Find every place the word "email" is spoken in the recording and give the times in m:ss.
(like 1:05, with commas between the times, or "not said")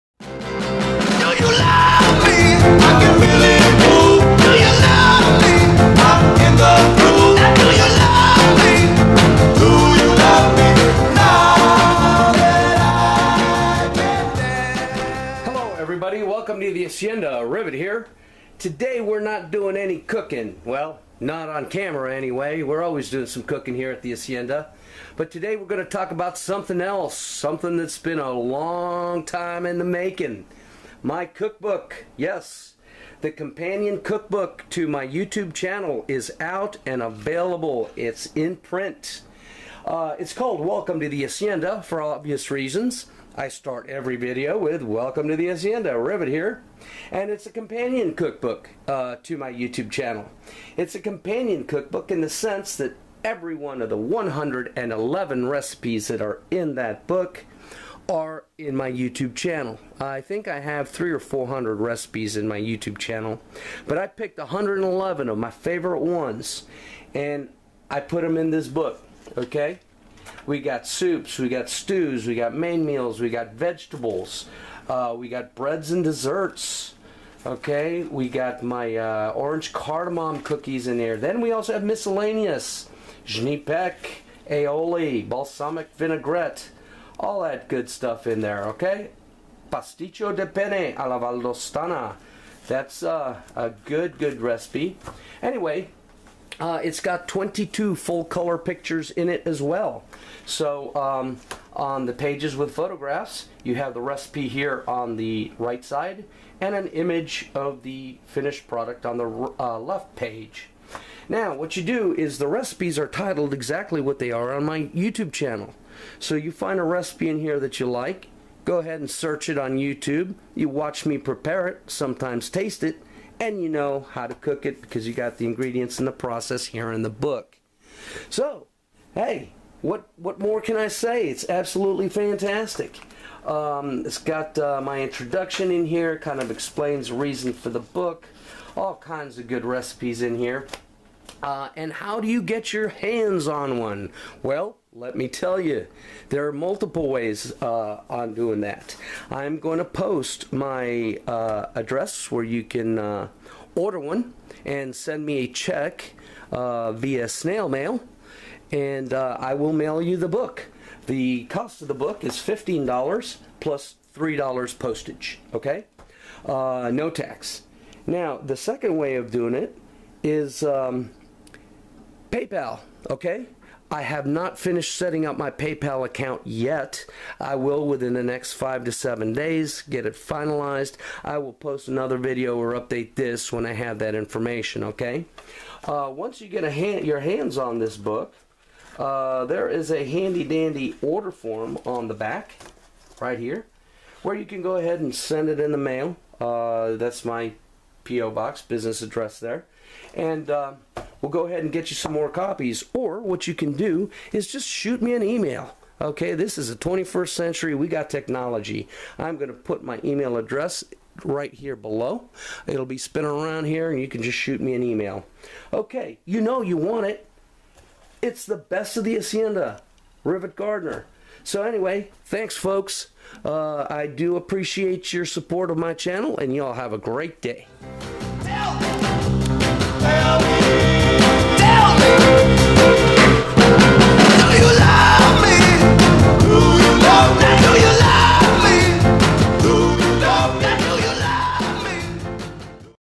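3:25, 3:30, 3:34.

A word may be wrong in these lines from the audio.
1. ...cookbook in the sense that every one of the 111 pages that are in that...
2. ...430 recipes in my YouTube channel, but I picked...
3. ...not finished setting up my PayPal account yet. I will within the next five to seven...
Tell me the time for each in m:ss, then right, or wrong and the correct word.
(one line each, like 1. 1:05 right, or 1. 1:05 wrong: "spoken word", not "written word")
1. 0:51 wrong: "recipes", not "pages"
2. 1:01 wrong: "400", not "430"
3. 2:54 right.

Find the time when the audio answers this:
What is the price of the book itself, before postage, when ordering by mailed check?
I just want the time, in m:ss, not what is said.
2:42.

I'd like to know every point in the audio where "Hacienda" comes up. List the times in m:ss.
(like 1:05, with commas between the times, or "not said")
0:16, 0:24, 0:41, 0:45, 3:39.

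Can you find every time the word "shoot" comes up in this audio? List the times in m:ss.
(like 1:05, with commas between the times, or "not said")
3:24, 3:34.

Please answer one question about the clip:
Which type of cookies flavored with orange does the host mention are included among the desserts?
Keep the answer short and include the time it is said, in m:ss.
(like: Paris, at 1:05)
orange cardamom cookies, at 1:19.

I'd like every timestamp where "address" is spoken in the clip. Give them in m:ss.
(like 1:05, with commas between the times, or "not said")
2:31, 3:19, 3:30.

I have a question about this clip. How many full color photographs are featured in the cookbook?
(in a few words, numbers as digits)
22.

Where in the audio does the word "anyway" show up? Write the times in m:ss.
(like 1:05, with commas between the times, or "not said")
0:22, 1:35, 3:41.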